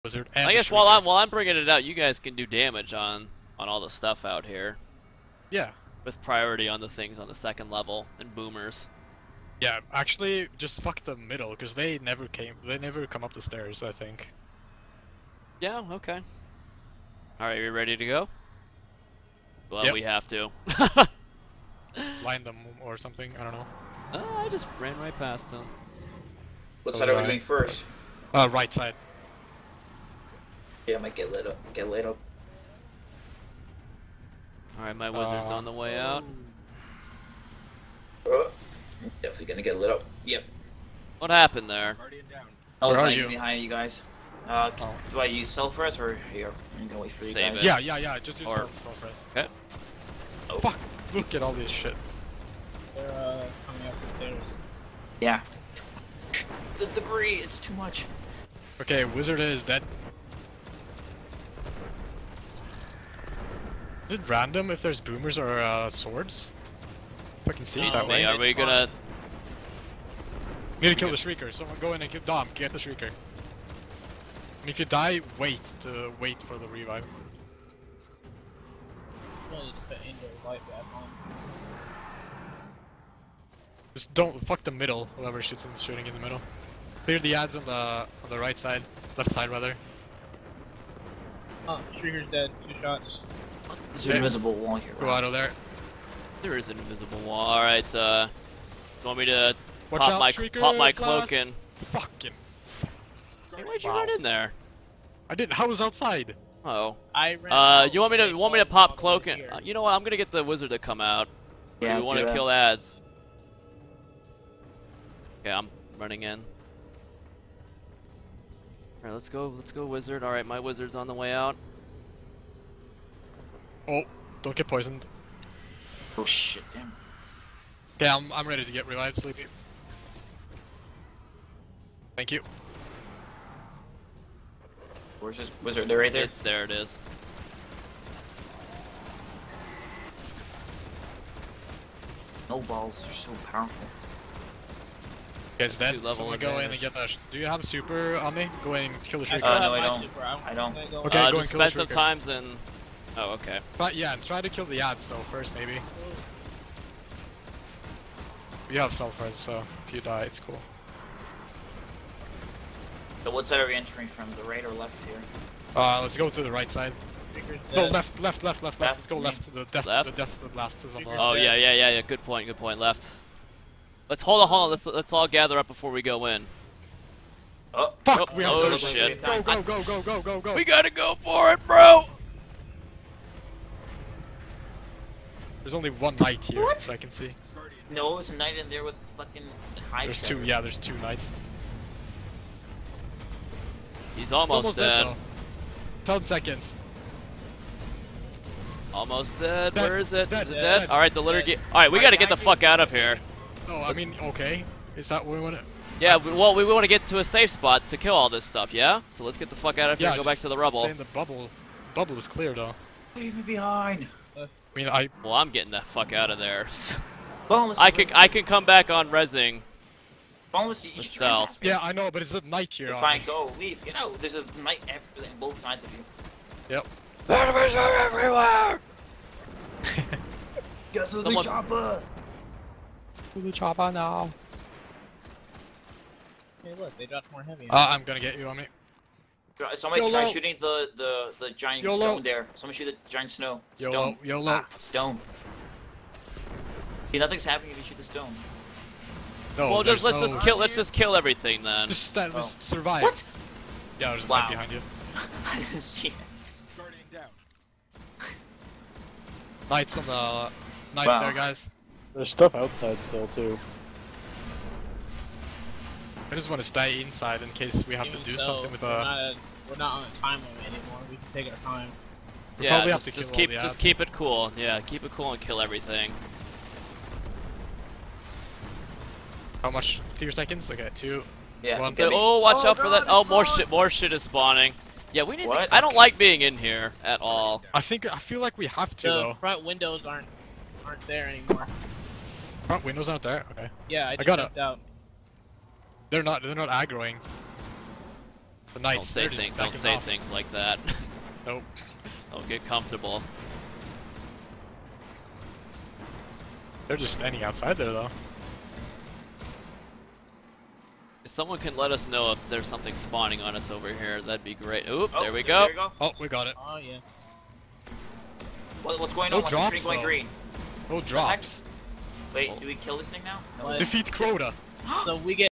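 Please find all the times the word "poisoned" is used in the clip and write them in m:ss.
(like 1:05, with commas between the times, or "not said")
2:04.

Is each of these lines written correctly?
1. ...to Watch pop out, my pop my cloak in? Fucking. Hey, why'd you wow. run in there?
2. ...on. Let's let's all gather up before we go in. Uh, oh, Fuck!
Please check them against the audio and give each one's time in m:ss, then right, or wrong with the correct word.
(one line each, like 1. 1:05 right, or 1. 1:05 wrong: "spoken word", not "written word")
1. 1:39 right
2. 2:54 right.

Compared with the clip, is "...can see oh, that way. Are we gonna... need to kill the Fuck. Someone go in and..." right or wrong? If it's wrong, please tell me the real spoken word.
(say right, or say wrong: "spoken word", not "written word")
wrong: "Shrieker", not "Fuck".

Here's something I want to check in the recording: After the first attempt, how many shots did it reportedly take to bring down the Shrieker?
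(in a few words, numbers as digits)
2.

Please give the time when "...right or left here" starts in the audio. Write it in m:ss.
2:44.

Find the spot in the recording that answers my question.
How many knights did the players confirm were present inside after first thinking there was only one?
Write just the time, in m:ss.
3:10.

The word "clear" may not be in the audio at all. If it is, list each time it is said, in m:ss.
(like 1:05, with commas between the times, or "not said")
1:27, 3:32.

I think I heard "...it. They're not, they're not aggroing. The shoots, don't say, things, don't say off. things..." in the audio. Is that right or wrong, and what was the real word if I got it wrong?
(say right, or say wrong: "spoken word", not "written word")
wrong: "knights", not "shoots".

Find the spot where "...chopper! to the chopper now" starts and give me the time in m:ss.
3:51.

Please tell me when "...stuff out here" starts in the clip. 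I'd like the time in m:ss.
0:03.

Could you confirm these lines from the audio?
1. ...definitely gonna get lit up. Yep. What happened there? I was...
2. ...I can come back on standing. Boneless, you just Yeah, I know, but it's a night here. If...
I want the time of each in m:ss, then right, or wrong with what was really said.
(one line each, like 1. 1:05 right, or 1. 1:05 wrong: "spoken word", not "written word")
1. 0:39 right
2. 3:38 wrong: "resing", not "standing".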